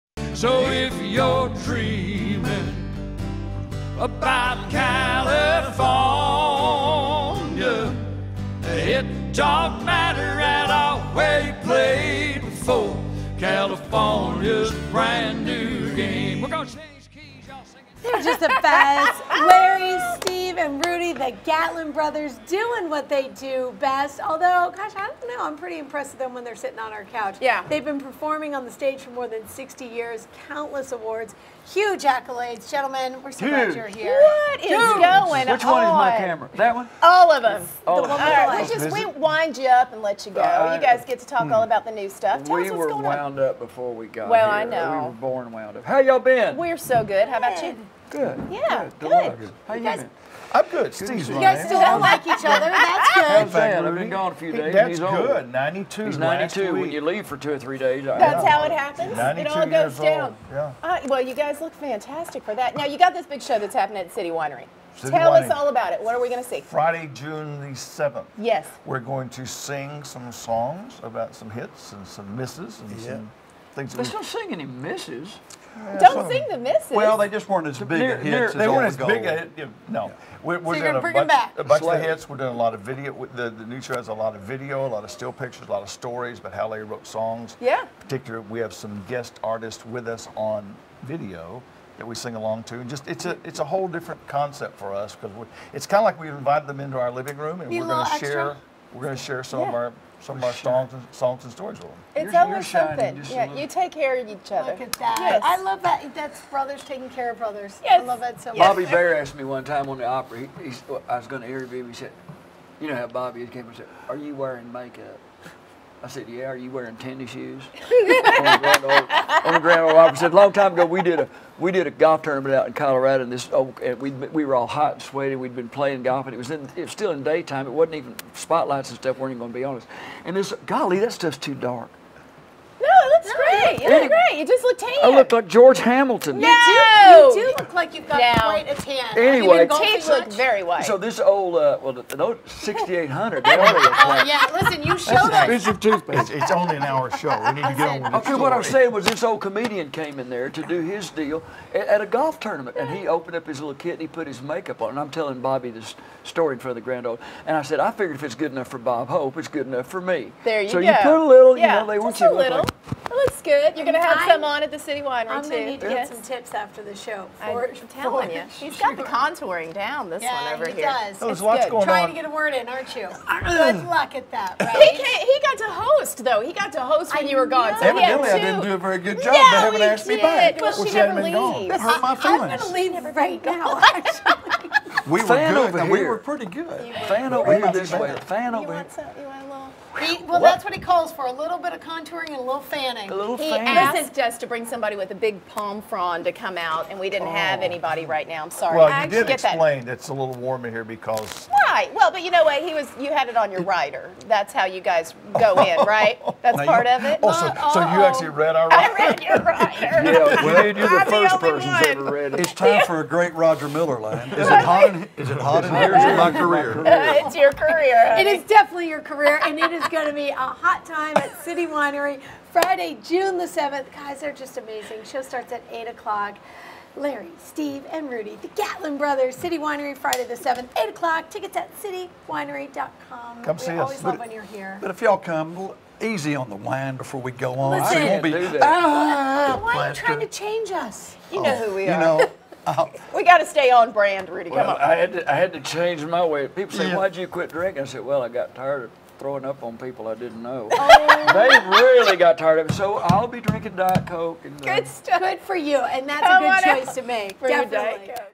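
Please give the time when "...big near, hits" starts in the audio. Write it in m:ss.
1:17.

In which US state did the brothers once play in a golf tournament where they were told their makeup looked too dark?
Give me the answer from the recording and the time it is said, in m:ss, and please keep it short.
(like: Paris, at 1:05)
Colorado, at 2:02.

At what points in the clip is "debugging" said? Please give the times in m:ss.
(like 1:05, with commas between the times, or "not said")
not said.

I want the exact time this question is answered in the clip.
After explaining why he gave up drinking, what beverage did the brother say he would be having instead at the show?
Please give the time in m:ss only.
4:13.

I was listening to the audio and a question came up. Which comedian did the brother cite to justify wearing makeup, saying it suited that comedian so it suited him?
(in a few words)
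Bob Hope.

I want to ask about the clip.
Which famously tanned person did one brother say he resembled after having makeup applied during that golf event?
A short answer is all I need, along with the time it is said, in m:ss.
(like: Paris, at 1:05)
George Hamilton, at 2:15.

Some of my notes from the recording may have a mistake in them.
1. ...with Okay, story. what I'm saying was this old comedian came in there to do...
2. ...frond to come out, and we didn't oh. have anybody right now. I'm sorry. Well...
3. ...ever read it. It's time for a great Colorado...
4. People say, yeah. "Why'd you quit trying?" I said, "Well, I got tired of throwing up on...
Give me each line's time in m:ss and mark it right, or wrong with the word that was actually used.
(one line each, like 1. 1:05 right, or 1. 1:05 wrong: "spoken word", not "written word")
1. 2:28 right
2. 3:15 right
3. 3:31 wrong: "Roger", not "Colorado"
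4. 4:06 wrong: "drinking", not "trying".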